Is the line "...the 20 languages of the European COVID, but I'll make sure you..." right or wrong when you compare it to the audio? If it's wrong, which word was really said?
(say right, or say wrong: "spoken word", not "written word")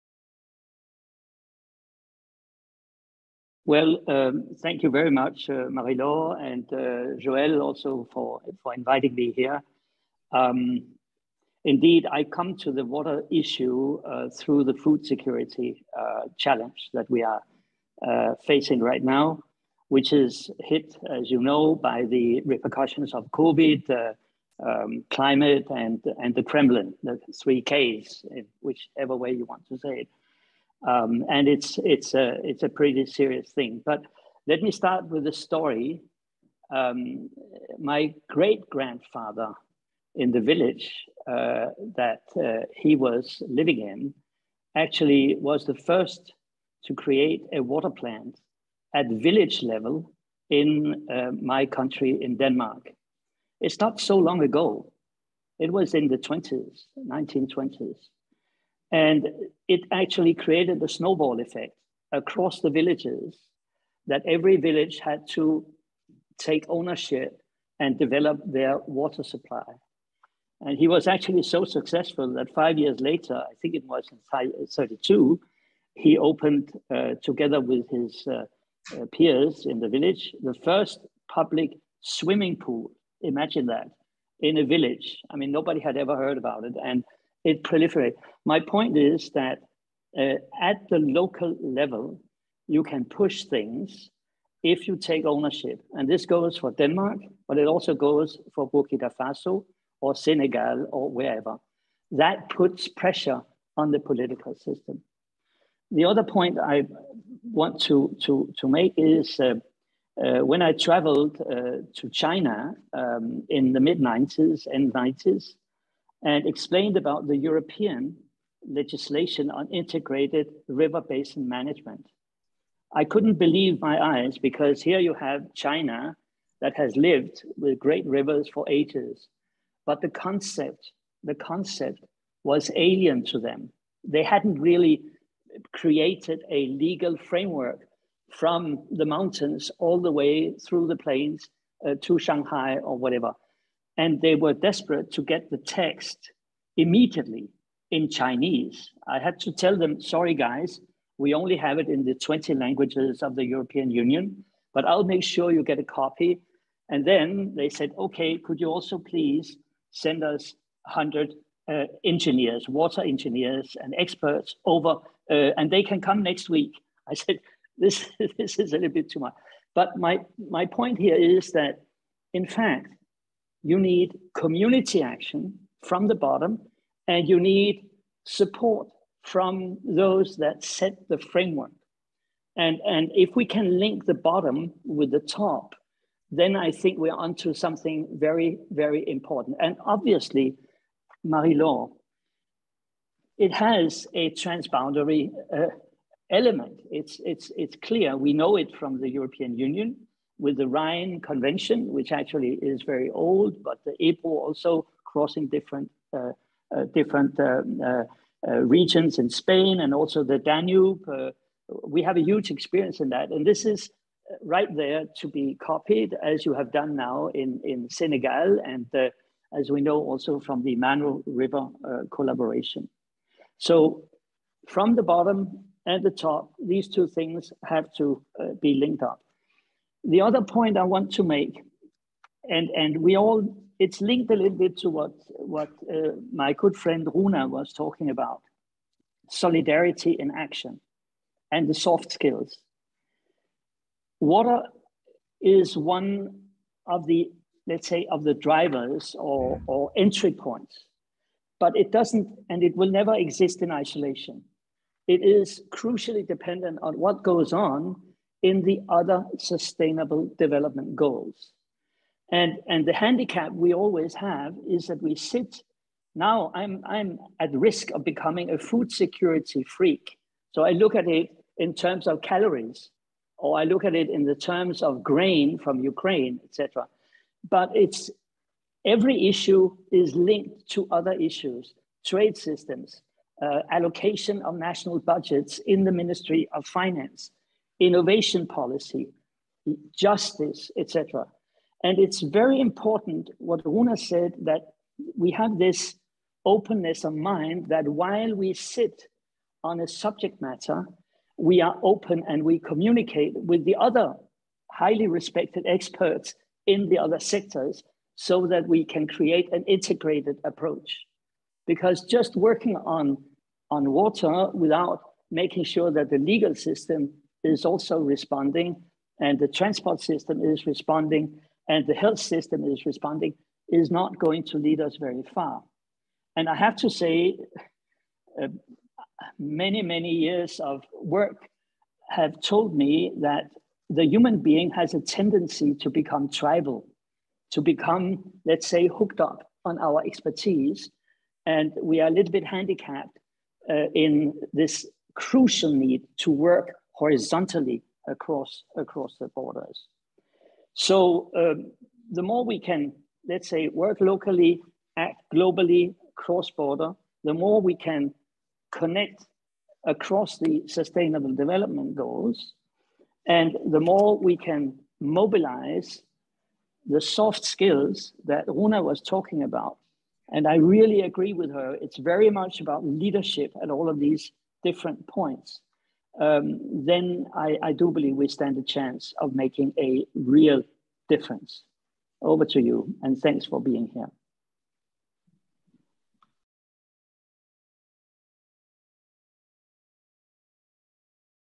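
wrong: "Union", not "COVID".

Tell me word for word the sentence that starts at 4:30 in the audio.
So I look at it in terms of calories, or I look at it in the terms of grain from Ukraine, etc.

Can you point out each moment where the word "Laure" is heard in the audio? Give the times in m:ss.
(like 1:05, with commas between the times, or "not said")
0:05, 3:11.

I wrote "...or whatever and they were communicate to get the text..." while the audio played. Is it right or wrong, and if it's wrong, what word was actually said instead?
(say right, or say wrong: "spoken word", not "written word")
wrong: "desperate", not "communicate".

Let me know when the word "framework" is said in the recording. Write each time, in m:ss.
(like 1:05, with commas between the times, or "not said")
2:17, 3:01.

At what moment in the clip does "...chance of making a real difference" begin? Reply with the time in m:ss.
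6:18.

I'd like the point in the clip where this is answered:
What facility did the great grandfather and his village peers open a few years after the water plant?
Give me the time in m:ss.
1:21.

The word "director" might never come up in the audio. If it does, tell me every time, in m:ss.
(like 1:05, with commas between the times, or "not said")
not said.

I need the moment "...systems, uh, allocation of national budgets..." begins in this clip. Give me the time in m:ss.
4:42.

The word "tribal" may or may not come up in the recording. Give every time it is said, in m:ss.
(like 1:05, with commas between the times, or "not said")
5:36.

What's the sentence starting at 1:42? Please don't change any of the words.
That puts pressure on the political system.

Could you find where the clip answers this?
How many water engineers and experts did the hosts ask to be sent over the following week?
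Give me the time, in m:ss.
2:40.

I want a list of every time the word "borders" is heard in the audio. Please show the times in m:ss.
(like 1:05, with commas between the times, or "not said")
5:49, 5:56.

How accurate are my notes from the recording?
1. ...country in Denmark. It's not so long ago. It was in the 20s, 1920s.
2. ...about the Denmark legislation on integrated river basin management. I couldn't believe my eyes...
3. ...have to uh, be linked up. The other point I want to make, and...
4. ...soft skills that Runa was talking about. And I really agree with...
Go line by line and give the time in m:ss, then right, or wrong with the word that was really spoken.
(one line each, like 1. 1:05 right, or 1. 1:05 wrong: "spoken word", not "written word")
1. 0:51 right
2. 1:56 wrong: "European", not "Denmark"
3. 3:47 right
4. 6:07 right.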